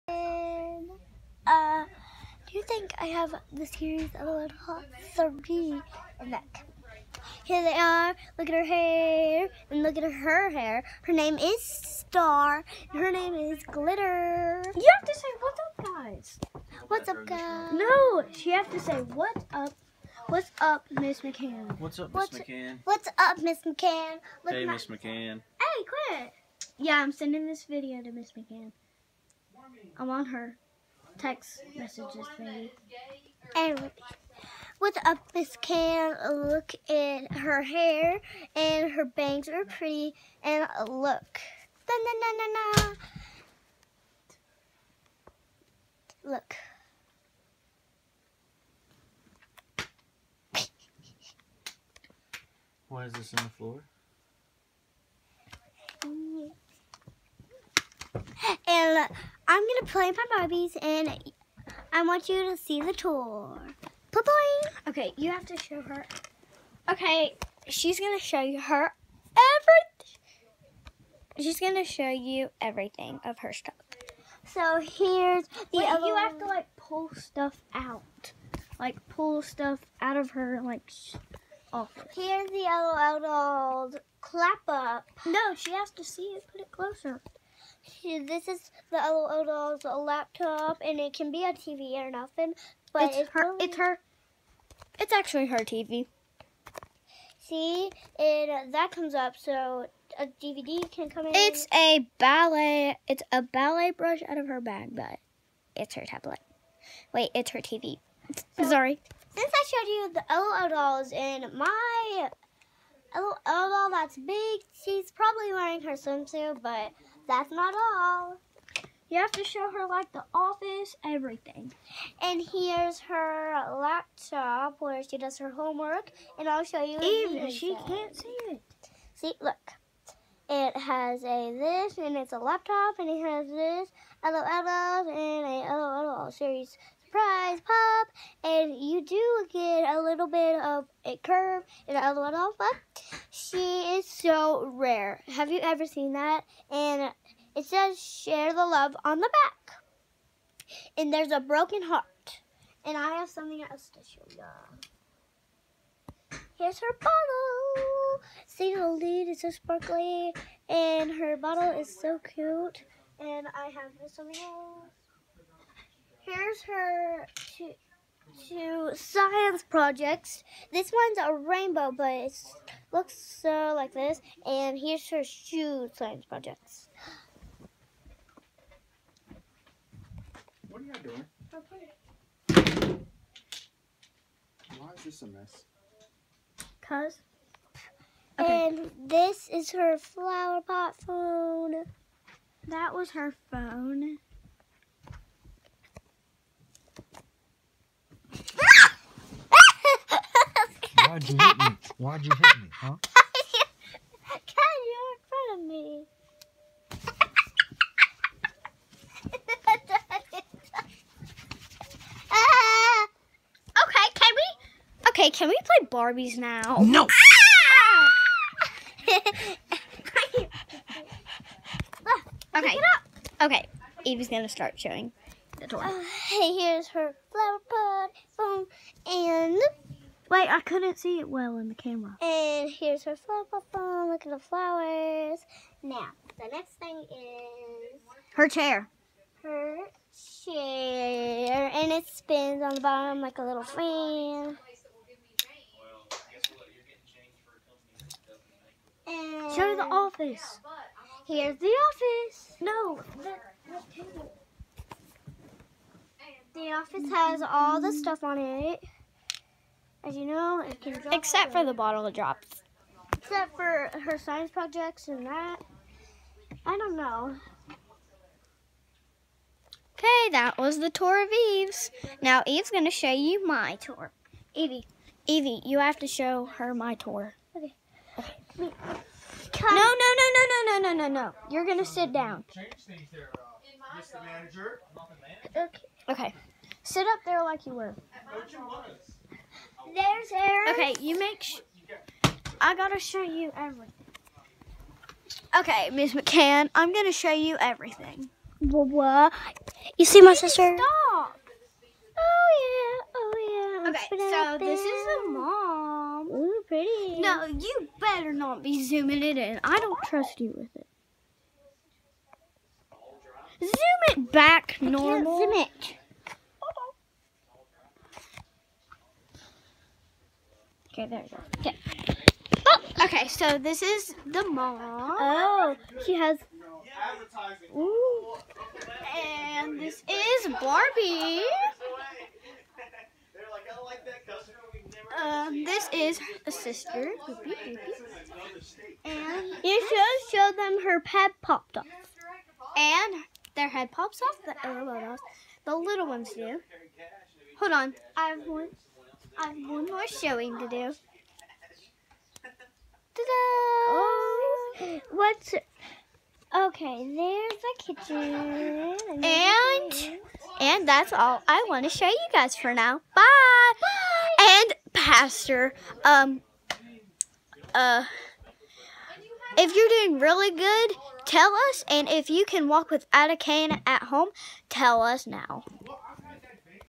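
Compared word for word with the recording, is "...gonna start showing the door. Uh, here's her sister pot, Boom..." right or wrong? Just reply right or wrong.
wrong.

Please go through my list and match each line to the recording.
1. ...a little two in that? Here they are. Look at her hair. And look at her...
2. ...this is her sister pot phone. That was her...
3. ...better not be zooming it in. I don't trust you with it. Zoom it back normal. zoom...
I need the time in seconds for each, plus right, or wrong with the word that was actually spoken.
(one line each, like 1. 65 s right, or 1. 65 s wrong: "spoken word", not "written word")
1. 4 s wrong: "three", not "two"
2. 189 s wrong: "flower", not "sister"
3. 307 s right.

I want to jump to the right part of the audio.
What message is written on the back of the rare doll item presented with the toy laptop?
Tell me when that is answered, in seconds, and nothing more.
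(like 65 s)
148 s.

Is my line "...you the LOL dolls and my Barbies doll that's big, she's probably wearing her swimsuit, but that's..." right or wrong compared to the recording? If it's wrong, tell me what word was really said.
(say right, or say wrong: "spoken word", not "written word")
wrong: "LOL", not "Barbies".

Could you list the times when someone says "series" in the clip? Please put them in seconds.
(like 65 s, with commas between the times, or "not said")
3 s, 136 s.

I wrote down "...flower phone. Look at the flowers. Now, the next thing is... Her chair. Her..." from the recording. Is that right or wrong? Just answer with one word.
right.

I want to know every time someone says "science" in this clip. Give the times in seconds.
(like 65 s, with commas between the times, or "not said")
168 s, 175 s, 264 s.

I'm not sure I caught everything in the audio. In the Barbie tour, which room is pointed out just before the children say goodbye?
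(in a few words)
The kitchen.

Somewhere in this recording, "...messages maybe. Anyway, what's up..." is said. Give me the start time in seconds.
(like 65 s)
31 s.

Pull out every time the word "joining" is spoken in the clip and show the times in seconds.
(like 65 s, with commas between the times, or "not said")
not said.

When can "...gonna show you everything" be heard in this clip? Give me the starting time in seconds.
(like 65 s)
296 s.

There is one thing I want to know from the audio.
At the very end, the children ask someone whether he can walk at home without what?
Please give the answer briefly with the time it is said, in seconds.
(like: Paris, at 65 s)
A cane, at 373 s.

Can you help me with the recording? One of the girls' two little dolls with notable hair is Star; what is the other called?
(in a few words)
Glitter.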